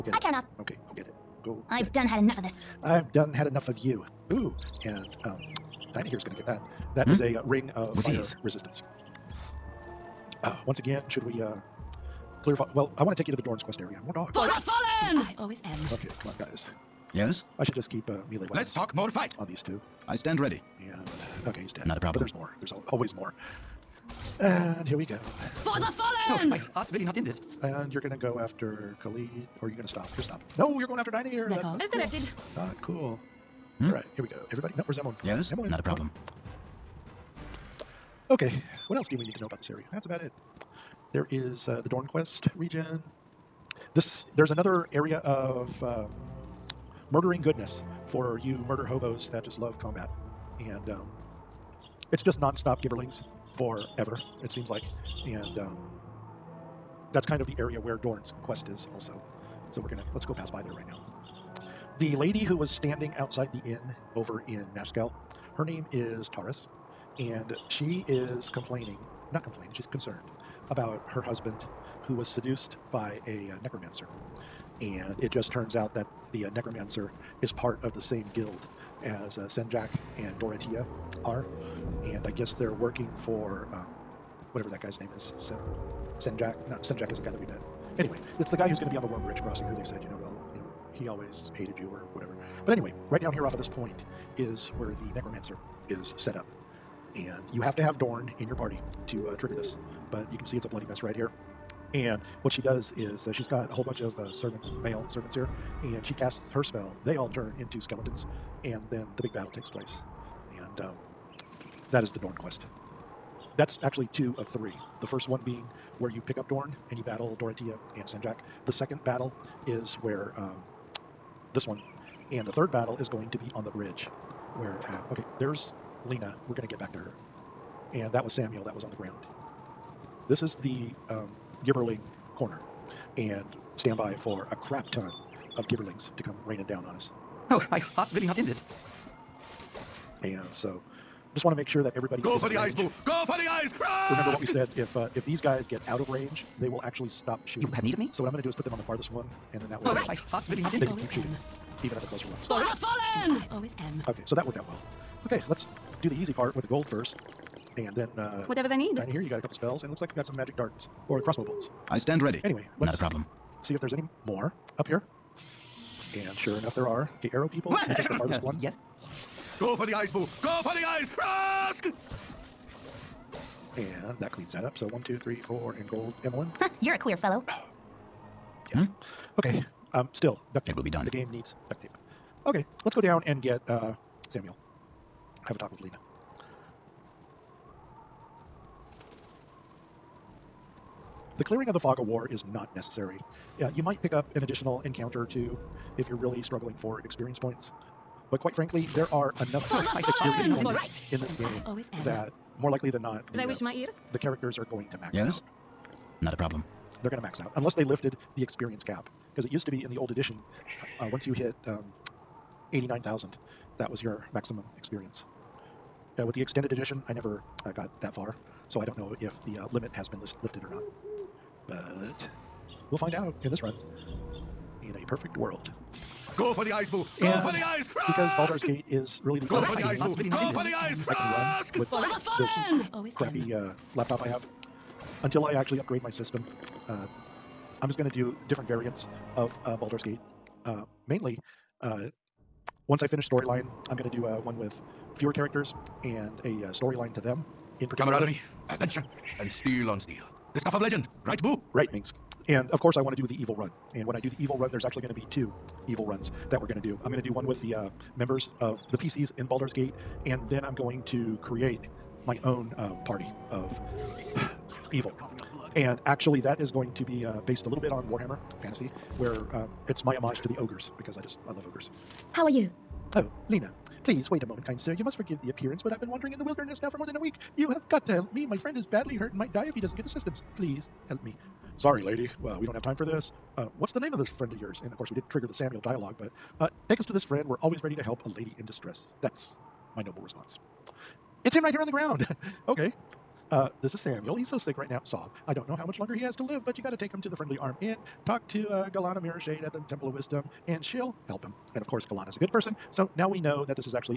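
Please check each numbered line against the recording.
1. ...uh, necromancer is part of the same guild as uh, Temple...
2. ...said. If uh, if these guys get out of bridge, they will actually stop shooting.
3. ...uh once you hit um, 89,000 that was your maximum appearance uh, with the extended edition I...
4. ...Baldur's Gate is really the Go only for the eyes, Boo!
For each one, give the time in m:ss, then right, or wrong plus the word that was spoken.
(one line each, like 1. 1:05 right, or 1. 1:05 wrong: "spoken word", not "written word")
1. 1:16 wrong: "Senjak", not "Temple"
2. 2:24 wrong: "range", not "bridge"
3. 3:31 wrong: "experience", not "appearance"
4. 3:48 right.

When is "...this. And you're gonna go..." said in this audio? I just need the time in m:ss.
0:27.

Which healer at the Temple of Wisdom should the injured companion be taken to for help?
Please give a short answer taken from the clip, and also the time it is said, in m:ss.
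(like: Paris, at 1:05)
Gellana Mirrorshade, at 4:58.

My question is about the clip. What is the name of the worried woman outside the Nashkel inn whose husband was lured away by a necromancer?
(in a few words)
Taurus.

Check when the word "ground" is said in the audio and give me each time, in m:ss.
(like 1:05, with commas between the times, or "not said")
2:08, 4:51.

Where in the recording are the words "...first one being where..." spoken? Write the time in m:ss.
1:55.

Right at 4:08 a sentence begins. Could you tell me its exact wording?
Camaraderie, adventure, and steel on steel.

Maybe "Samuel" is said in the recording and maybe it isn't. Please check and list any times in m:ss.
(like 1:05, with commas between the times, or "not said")
2:08, 3:04, 4:45, 4:53.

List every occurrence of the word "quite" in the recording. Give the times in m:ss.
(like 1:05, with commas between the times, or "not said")
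3:18.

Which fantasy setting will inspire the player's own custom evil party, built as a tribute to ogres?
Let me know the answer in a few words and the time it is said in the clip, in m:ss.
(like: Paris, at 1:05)
Warhammer fantasy, at 4:28.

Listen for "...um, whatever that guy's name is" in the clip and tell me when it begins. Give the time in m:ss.
1:23.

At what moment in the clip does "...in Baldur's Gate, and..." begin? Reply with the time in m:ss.
4:19.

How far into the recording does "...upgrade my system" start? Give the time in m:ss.
3:55.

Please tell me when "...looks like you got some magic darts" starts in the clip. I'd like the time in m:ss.
2:39.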